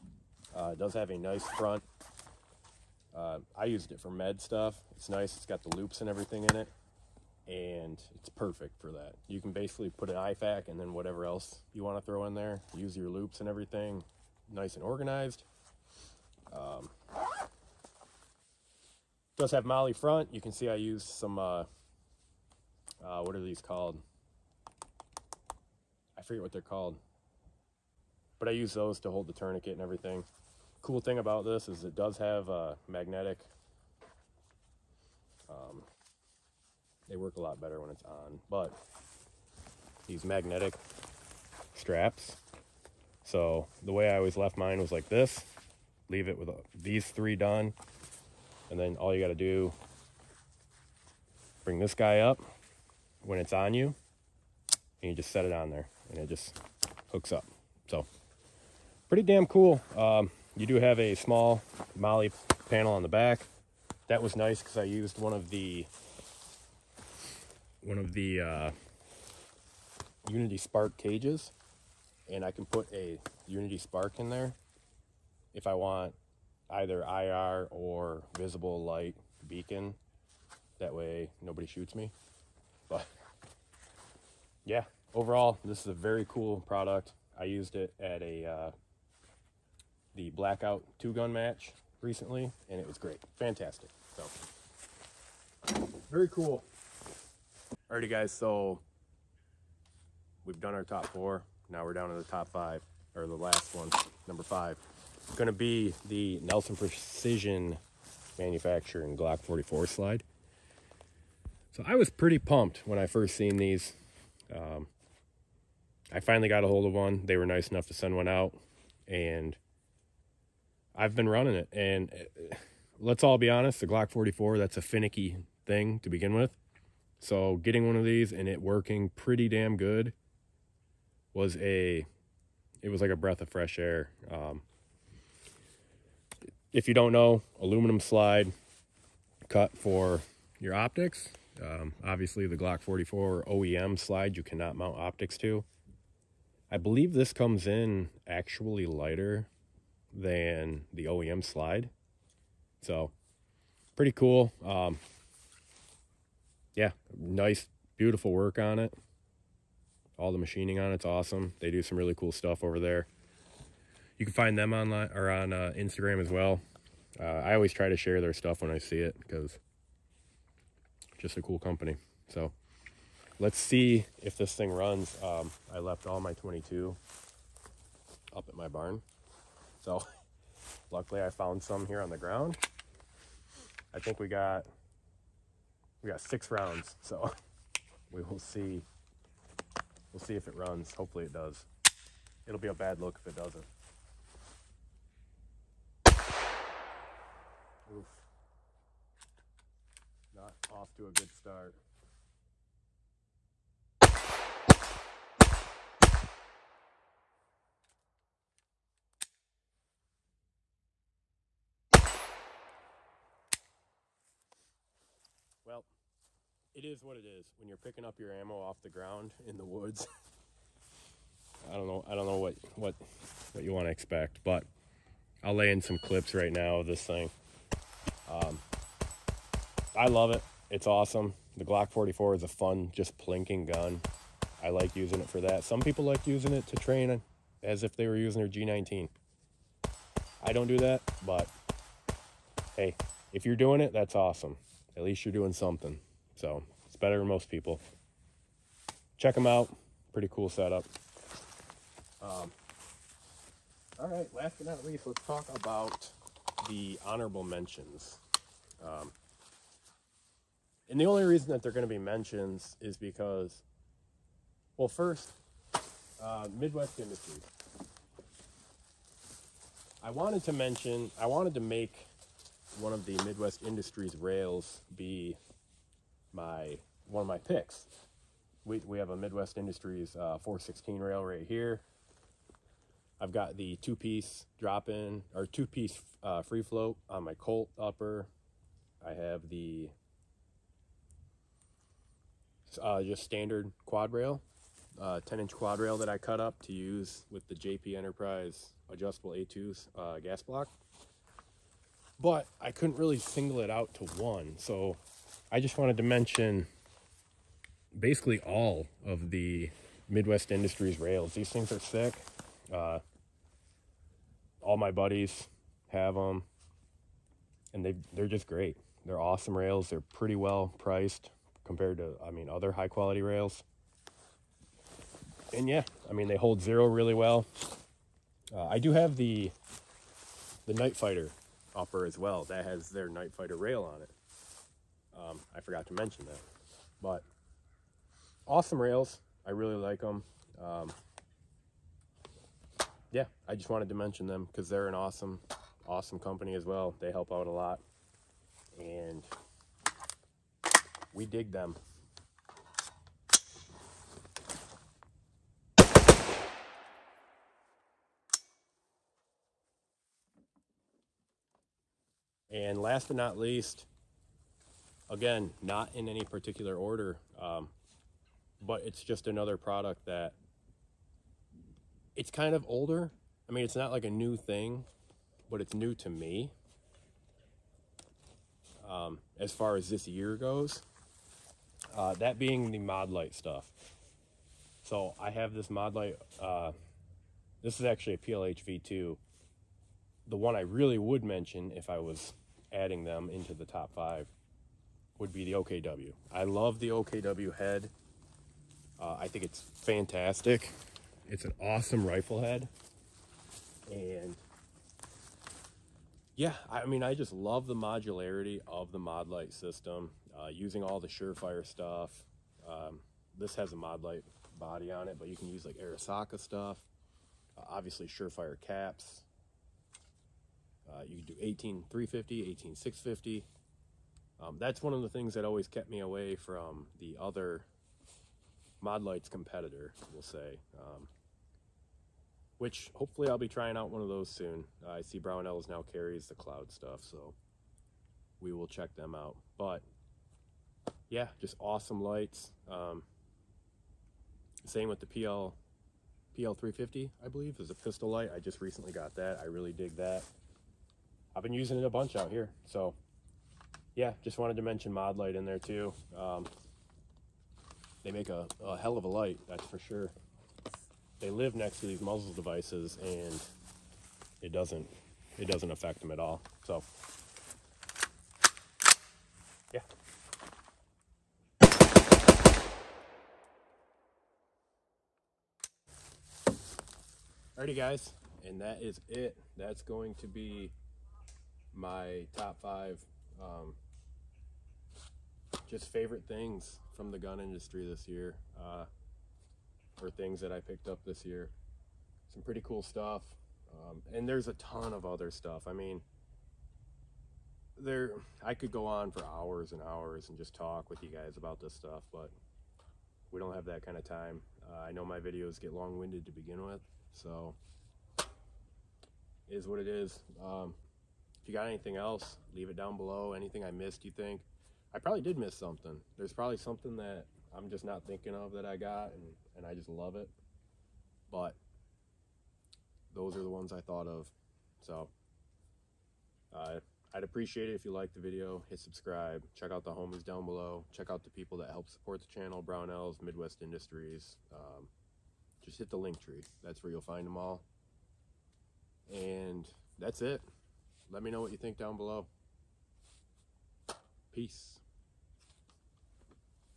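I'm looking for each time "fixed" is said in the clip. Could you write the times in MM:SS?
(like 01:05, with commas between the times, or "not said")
not said.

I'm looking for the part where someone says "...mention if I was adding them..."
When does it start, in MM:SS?
06:31.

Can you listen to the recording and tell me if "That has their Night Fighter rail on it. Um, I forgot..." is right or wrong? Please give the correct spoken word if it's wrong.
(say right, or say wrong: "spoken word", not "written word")
right.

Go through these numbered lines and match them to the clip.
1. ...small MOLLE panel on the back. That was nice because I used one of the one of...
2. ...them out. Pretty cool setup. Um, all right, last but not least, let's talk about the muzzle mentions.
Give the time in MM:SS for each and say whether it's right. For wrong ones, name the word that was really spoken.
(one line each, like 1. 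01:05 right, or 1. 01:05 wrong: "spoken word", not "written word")
1. 01:01 right
2. 04:09 wrong: "honorable", not "muzzle".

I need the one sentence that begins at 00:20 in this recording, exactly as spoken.
You can see I use some, uh, uh, what are these called?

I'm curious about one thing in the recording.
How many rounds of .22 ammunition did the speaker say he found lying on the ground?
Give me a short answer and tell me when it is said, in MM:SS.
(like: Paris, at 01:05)
6, at 03:06.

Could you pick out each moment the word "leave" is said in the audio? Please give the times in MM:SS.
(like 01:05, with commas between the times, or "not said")
00:46, 08:32.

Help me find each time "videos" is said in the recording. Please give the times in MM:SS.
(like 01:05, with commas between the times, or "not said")
08:25, 08:48.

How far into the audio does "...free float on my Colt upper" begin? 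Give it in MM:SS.
04:46.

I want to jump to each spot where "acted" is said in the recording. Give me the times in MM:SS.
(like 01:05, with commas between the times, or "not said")
not said.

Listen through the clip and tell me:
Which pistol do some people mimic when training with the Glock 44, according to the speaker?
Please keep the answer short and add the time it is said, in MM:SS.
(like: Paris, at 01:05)
G19, at 03:58.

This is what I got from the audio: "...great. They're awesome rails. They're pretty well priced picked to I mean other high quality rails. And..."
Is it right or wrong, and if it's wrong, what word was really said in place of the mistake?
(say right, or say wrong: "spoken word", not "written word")
wrong: "compared", not "picked".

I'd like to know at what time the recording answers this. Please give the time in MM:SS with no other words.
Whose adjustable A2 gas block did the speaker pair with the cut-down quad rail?
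04:57.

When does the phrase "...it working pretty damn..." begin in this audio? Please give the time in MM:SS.
02:08.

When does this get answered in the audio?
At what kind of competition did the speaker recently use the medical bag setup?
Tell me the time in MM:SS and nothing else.
01:30.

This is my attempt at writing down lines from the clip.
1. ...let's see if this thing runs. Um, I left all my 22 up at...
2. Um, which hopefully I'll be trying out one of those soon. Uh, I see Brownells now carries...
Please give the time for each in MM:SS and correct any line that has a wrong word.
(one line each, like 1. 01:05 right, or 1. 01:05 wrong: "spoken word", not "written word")
1. 02:53 right
2. 07:10 right.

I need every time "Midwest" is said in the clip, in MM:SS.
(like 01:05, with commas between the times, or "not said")
04:26, 04:33, 04:39, 05:10, 08:53.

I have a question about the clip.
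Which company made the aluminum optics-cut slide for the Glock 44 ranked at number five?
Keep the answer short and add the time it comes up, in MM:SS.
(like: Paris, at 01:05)
Nelson Precision Manufacturing, at 01:46.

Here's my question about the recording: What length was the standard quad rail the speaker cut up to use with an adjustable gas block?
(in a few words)
10-inch.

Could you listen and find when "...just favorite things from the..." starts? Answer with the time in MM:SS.
08:05.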